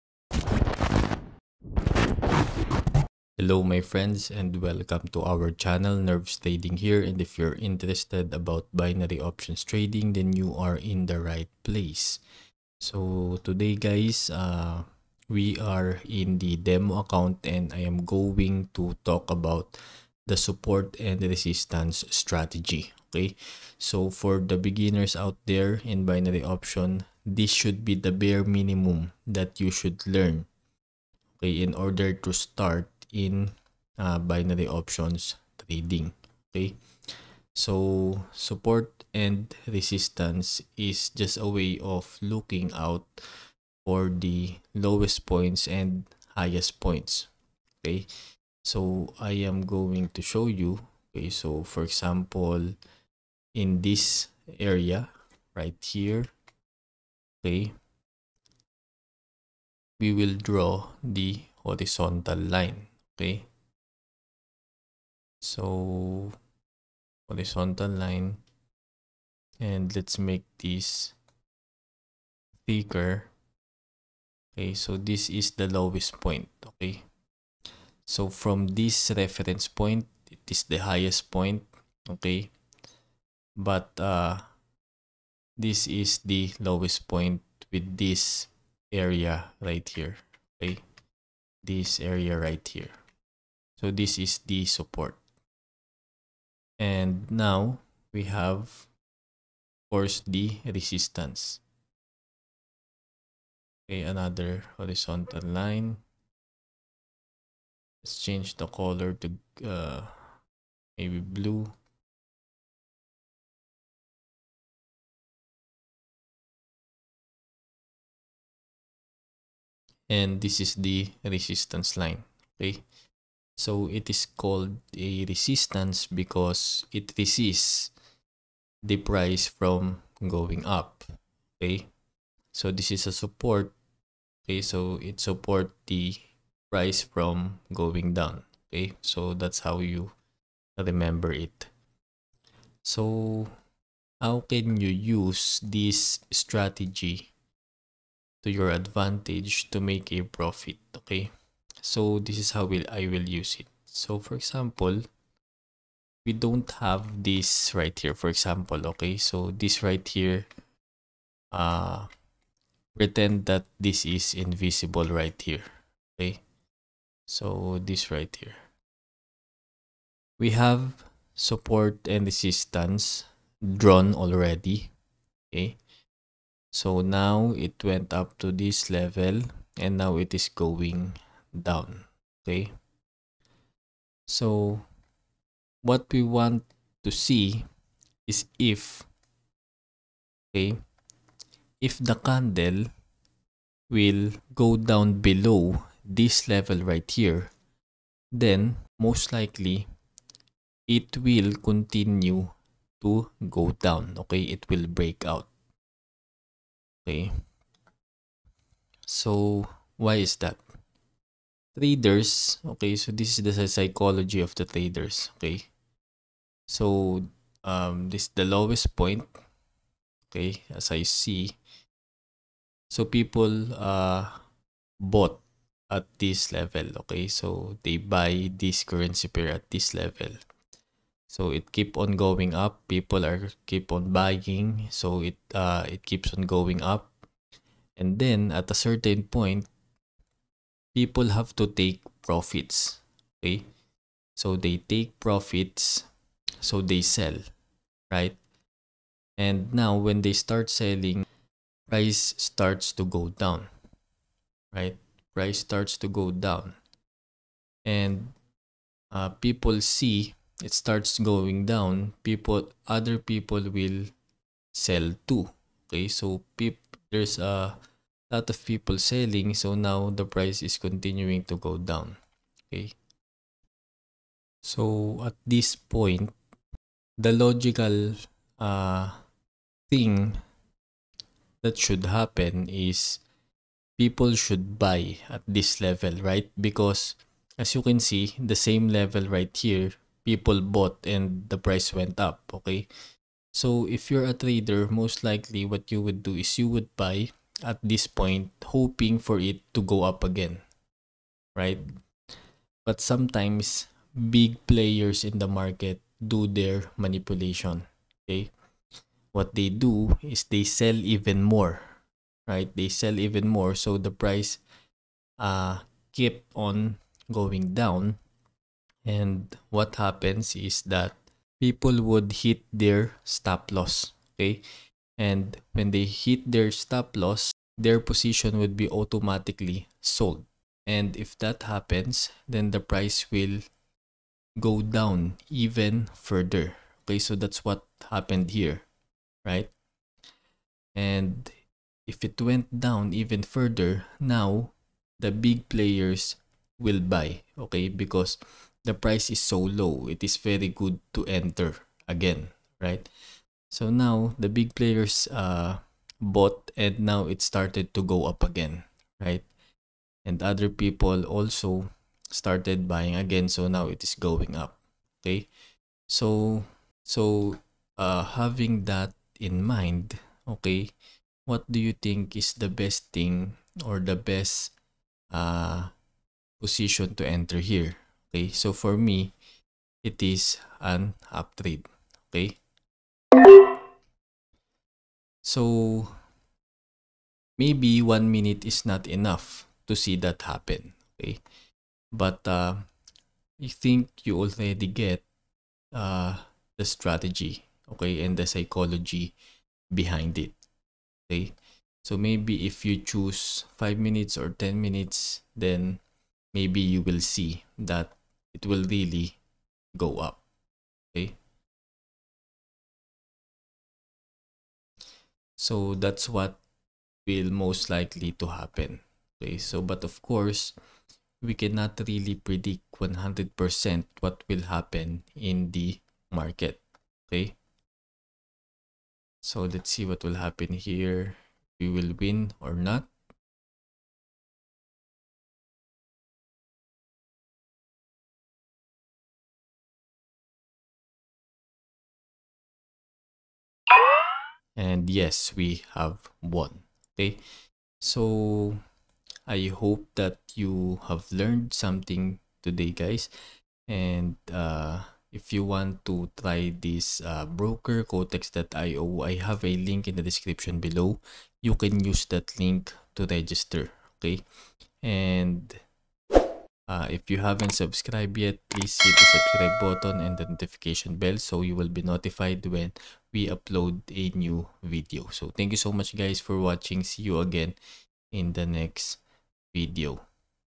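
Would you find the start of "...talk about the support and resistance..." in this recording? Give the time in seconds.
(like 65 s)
19 s.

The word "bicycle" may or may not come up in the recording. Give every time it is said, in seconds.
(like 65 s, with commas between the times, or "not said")
not said.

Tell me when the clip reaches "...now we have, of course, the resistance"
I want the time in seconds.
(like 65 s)
97 s.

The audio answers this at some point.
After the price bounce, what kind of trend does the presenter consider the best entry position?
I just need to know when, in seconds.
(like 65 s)
381 s.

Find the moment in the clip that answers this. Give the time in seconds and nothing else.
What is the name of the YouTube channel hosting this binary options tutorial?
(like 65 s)
5 s.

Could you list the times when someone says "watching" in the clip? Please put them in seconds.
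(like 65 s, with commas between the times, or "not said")
476 s.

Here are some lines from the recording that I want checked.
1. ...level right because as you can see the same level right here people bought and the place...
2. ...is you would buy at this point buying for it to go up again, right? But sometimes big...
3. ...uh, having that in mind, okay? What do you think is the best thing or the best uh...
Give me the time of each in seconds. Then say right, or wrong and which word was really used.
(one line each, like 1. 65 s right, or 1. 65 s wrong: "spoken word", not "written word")
1. 285 s wrong: "price", not "place"
2. 296 s wrong: "hoping", not "buying"
3. 367 s right.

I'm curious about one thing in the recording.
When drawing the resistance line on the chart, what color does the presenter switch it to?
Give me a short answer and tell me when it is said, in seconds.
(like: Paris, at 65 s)
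blue, at 111 s.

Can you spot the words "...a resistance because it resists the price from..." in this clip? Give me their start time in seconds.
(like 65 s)
124 s.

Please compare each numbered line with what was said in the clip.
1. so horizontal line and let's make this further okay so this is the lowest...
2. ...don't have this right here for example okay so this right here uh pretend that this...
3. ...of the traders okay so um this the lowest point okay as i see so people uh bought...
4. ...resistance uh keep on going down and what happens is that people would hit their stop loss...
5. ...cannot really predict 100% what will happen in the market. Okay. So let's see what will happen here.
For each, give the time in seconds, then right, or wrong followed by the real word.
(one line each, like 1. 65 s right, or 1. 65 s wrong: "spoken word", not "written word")
1. 65 s wrong: "thicker", not "further"
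2. 156 s right
3. 214 s right
4. 314 s wrong: "price", not "resistance"
5. 421 s right.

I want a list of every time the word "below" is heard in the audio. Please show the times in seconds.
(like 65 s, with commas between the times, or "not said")
195 s, 460 s.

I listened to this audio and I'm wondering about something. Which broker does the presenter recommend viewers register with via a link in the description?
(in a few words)
Quotex.io.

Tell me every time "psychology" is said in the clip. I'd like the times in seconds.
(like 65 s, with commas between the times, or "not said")
213 s, 398 s.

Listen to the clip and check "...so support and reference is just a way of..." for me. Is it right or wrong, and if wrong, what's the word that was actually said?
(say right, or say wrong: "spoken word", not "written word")
wrong: "resistance", not "reference".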